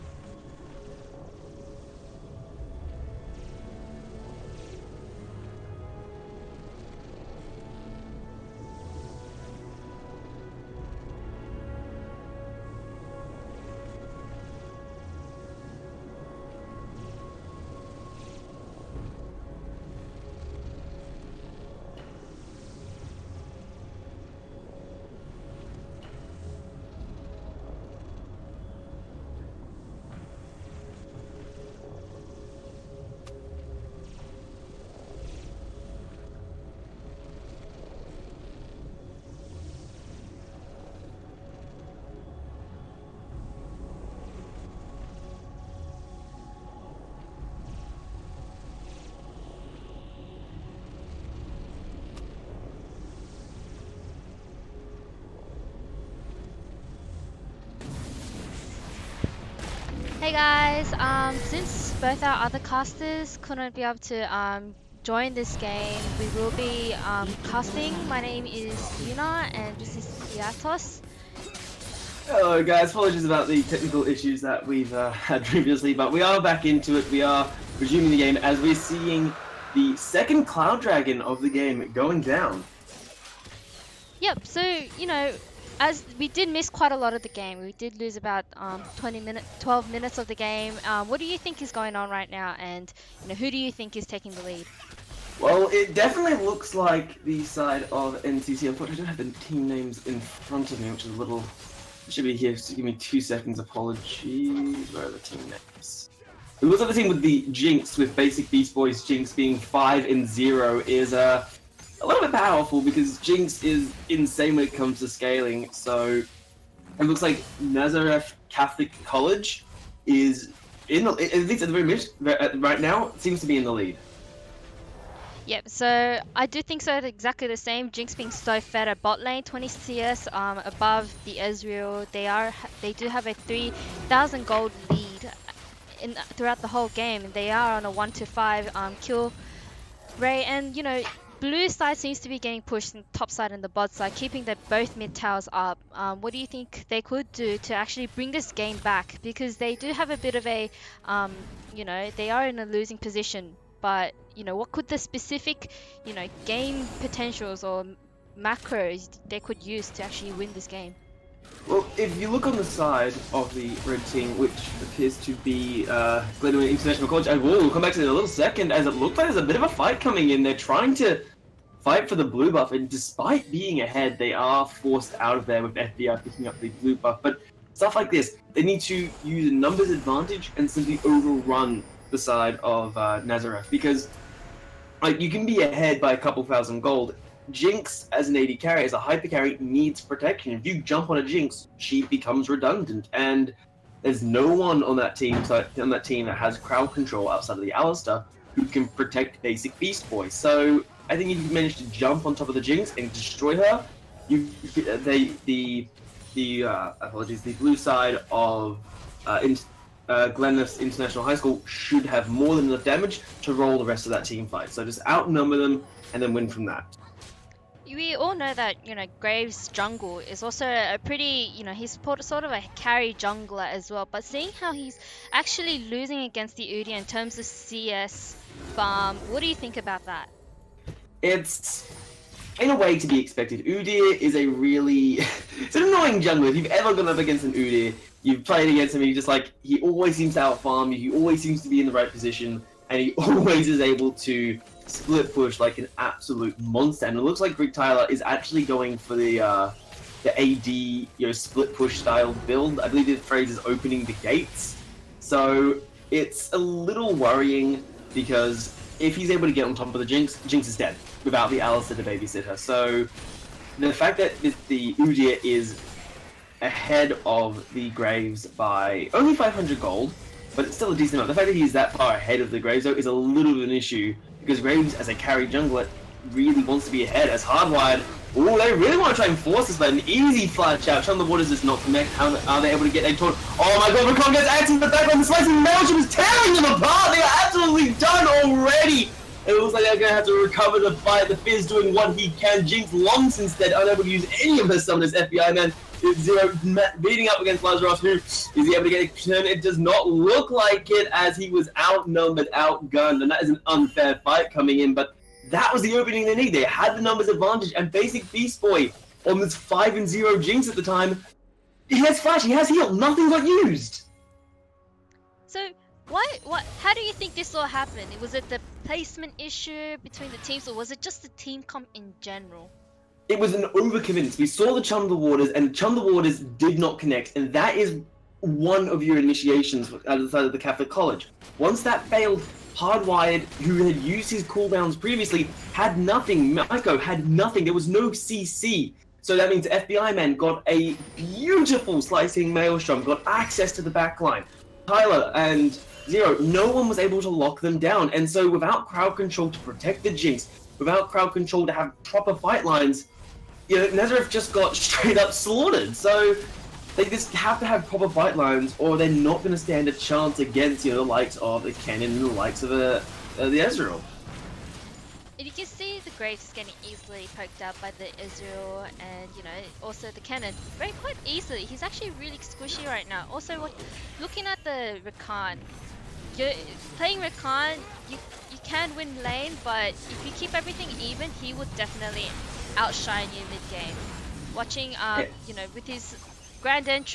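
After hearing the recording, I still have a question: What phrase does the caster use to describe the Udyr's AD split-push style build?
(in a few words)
opening the gates.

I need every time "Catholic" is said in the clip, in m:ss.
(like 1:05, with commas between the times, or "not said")
1:58, 5:30.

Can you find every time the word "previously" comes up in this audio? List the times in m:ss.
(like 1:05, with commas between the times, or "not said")
1:15, 5:34.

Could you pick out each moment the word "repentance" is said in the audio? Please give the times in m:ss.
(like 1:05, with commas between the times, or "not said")
not said.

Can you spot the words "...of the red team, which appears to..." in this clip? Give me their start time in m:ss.
2:43.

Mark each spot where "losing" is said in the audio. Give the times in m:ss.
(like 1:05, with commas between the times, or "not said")
2:32, 3:45.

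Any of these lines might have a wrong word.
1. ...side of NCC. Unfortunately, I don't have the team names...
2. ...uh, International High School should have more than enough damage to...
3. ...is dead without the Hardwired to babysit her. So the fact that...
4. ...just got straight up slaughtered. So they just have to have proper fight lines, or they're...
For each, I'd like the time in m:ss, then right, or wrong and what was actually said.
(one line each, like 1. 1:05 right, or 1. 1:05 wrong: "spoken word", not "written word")
1. 1:37 right
2. 3:30 right
3. 4:20 wrong: "Alistar", not "Hardwired"
4. 5:54 right.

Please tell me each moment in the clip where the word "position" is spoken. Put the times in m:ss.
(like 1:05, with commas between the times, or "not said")
2:32, 4:02.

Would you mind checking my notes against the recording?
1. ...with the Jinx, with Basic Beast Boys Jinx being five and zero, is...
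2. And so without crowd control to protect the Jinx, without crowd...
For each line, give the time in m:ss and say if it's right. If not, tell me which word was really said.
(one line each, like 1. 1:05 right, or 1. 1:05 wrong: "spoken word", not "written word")
1. 1:47 right
2. 5:48 right.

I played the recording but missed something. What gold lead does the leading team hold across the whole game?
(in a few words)
3,000.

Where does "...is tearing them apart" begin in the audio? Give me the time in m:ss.
4:45.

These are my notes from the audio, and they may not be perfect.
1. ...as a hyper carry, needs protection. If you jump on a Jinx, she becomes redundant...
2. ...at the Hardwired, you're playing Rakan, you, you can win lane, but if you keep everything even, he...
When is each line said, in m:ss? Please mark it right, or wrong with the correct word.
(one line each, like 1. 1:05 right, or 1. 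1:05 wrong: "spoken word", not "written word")
1. 3:08 right
2. 6:14 wrong: "Rakan", not "Hardwired".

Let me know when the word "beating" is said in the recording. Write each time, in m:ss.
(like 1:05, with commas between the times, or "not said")
4:57.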